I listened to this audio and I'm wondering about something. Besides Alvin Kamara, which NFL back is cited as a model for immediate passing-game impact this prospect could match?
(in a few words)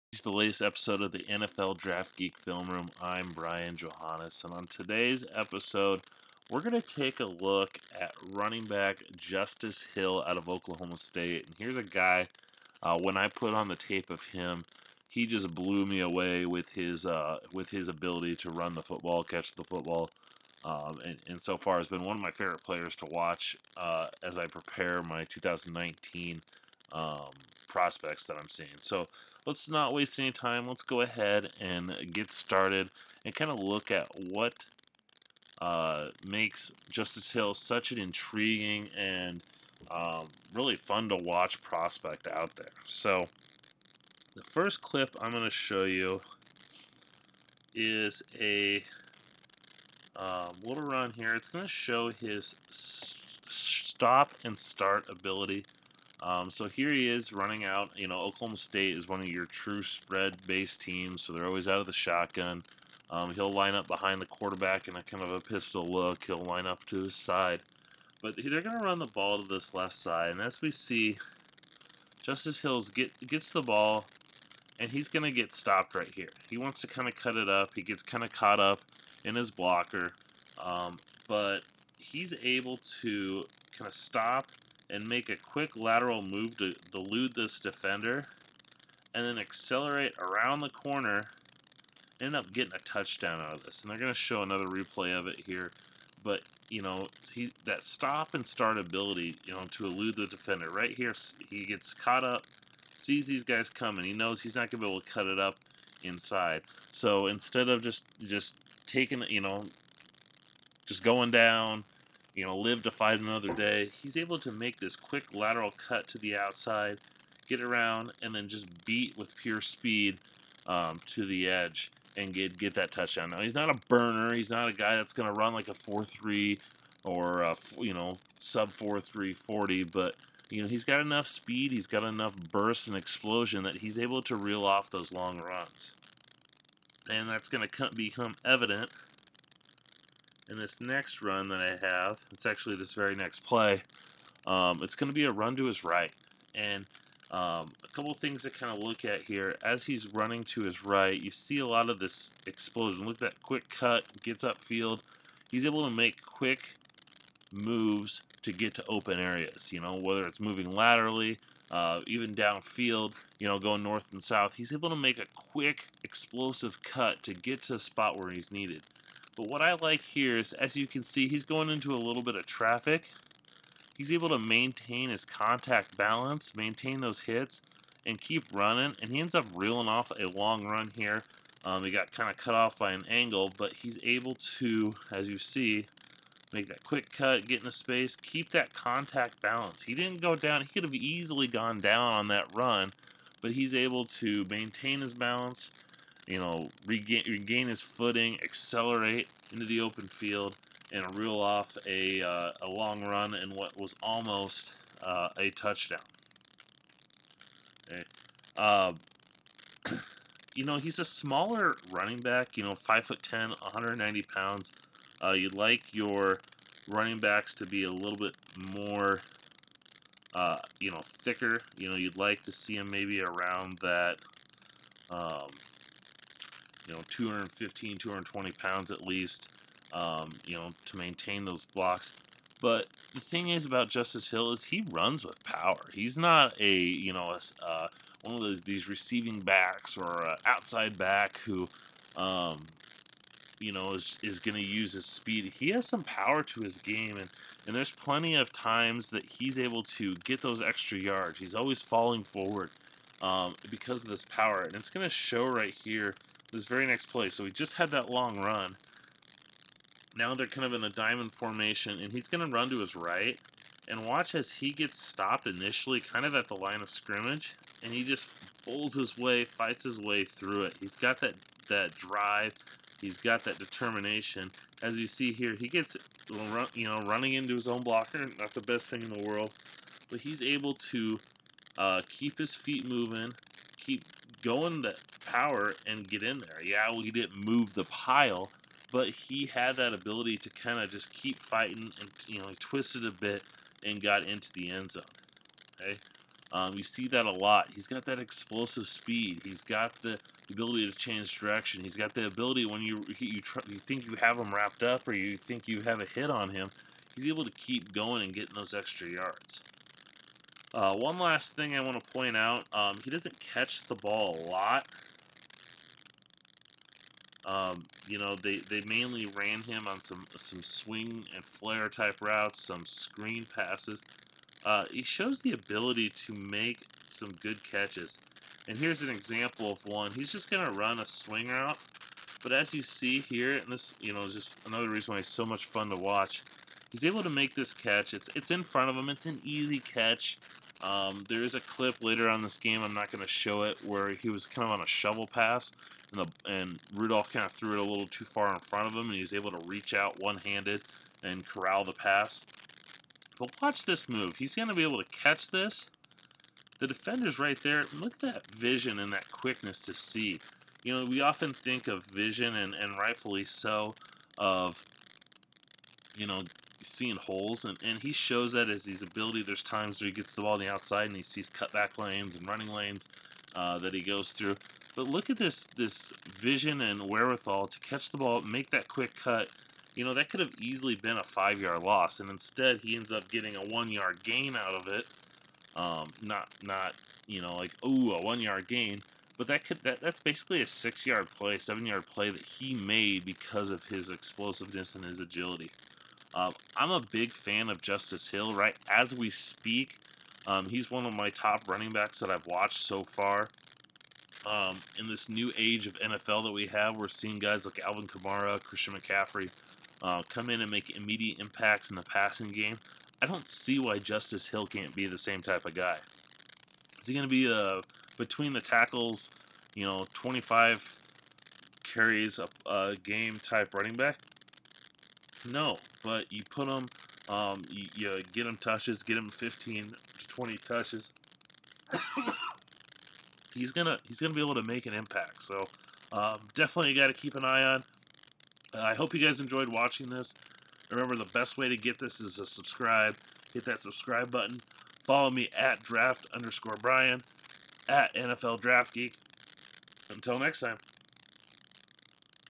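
Christian McCaffrey.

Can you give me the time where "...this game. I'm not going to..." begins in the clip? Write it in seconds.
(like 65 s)
342 s.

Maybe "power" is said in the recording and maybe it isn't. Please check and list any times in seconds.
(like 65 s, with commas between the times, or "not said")
235 s, 246 s, 254 s, 285 s.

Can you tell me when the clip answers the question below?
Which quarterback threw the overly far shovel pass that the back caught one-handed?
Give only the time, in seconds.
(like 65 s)
346 s.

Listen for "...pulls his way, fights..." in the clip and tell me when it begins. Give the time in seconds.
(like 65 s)
268 s.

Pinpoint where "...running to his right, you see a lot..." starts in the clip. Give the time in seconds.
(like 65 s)
150 s.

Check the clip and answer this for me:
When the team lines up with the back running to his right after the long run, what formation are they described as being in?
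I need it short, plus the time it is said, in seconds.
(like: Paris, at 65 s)
diamond formation, at 260 s.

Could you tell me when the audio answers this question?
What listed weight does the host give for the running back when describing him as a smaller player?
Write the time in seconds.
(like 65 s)
213 s.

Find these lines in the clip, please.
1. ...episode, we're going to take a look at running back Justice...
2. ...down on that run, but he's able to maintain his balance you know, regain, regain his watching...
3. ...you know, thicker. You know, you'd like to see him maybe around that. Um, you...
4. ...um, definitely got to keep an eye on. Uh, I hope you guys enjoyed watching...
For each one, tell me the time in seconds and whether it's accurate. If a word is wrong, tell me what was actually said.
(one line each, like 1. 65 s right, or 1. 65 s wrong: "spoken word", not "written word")
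1. 5 s right
2. 191 s wrong: "footing", not "watching"
3. 220 s right
4. 436 s right.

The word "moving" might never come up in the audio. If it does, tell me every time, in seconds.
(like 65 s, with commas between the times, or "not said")
160 s, 282 s.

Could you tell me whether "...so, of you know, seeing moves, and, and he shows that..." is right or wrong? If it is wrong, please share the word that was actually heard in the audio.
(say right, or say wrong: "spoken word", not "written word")
wrong: "holes", not "moves".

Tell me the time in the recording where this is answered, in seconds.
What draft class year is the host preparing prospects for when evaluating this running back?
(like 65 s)
25 s.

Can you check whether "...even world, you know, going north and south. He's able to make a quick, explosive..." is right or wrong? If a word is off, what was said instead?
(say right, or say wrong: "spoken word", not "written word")
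wrong: "downfield", not "world".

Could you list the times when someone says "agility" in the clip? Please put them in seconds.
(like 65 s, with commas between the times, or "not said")
395 s.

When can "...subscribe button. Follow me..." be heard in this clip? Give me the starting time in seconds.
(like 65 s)
443 s.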